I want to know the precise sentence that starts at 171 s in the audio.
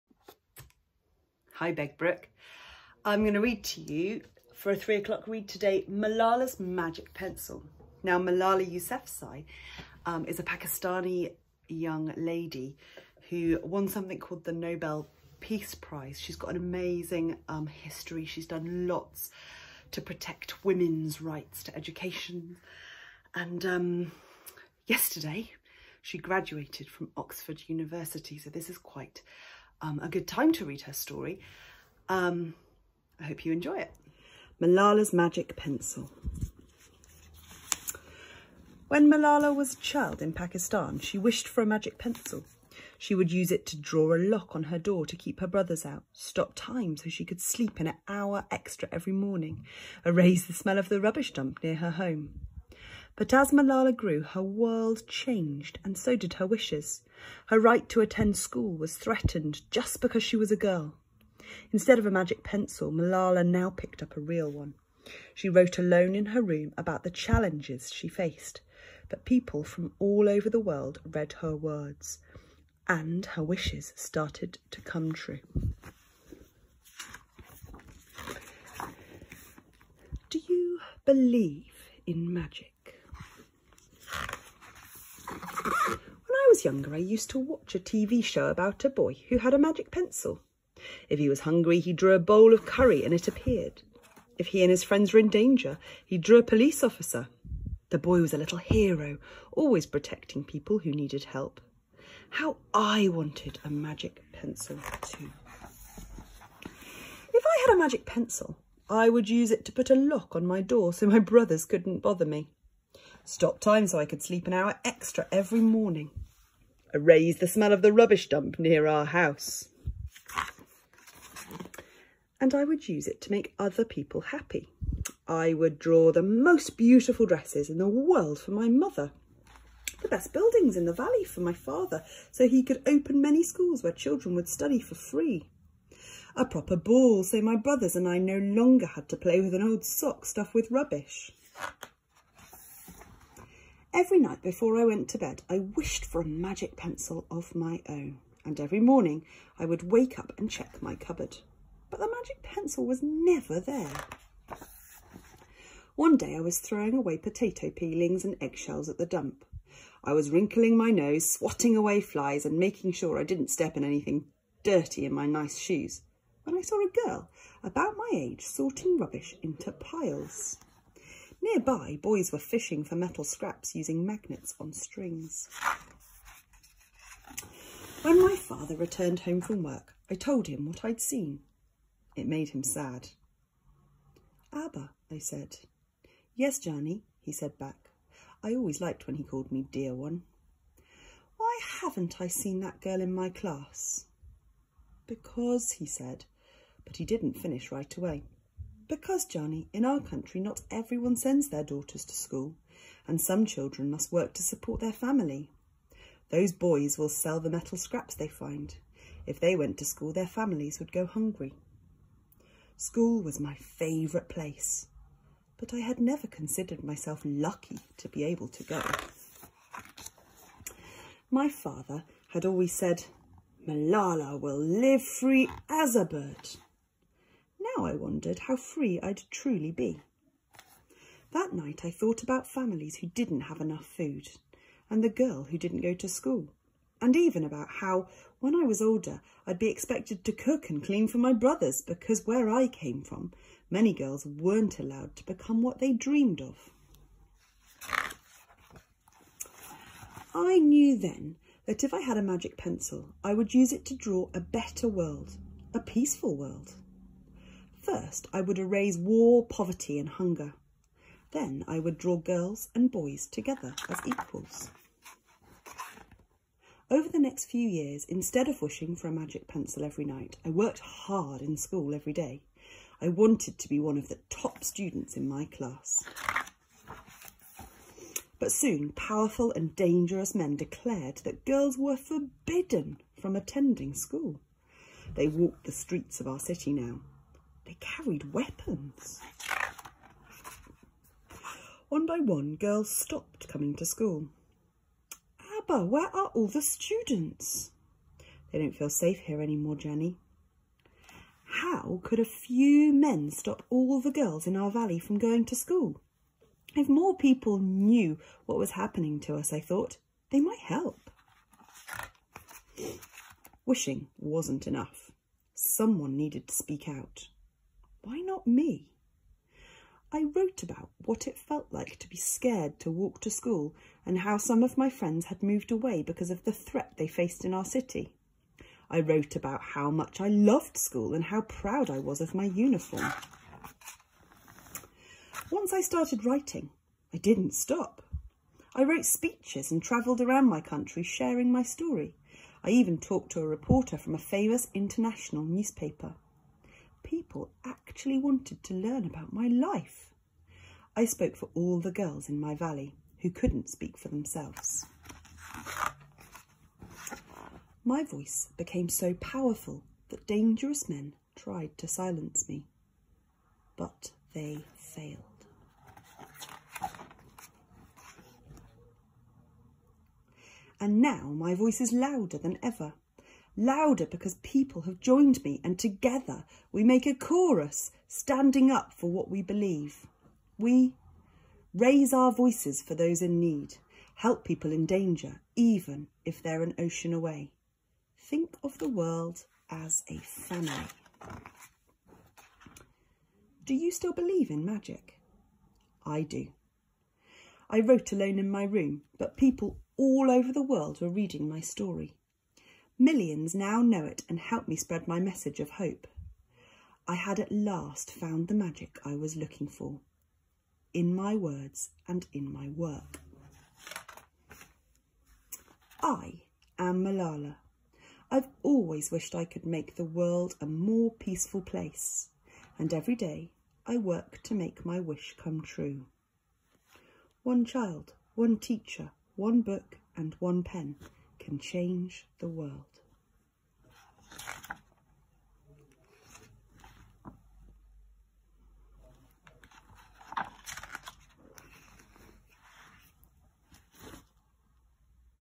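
Nearby, boys were fishing for metal scraps using magnets on strings.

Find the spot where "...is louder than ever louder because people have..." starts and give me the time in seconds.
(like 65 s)
371 s.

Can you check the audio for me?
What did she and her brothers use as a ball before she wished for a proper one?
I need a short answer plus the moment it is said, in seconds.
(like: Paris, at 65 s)
an old sock, at 139 s.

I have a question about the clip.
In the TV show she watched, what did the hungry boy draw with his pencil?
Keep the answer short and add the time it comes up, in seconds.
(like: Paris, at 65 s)
a bowl of curry, at 92 s.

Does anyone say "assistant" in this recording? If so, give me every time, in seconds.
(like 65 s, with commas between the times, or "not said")
not said.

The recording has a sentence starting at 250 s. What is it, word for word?
I knew then that if I had a magic pencil, I would use it to draw a better world, a peaceful world.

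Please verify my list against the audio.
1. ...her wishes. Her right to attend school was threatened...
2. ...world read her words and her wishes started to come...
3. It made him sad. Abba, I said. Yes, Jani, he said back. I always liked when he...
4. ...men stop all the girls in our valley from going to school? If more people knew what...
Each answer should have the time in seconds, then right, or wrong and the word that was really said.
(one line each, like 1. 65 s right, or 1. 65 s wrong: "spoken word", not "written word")
1. 56 s right
2. 70 s right
3. 182 s right
4. 302 s right.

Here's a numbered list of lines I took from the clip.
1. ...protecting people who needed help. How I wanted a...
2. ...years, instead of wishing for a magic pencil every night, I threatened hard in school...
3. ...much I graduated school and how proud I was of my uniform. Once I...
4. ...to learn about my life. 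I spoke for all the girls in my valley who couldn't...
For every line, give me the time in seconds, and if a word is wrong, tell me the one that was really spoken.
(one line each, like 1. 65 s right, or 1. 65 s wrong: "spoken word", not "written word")
1. 99 s right
2. 267 s wrong: "worked", not "threatened"
3. 329 s wrong: "loved", not "graduated"
4. 348 s right.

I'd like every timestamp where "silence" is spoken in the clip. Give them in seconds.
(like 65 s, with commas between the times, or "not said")
361 s.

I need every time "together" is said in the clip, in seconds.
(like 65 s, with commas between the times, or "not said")
263 s, 375 s.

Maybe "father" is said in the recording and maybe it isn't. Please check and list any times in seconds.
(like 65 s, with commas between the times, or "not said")
131 s, 178 s, 221 s.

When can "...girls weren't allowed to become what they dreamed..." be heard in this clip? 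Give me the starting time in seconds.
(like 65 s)
243 s.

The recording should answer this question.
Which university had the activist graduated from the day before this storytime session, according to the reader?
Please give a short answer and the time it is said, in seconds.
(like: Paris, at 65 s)
Oxford University, at 27 s.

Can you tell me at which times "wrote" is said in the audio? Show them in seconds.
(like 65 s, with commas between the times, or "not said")
65 s, 320 s, 329 s, 338 s, 397 s.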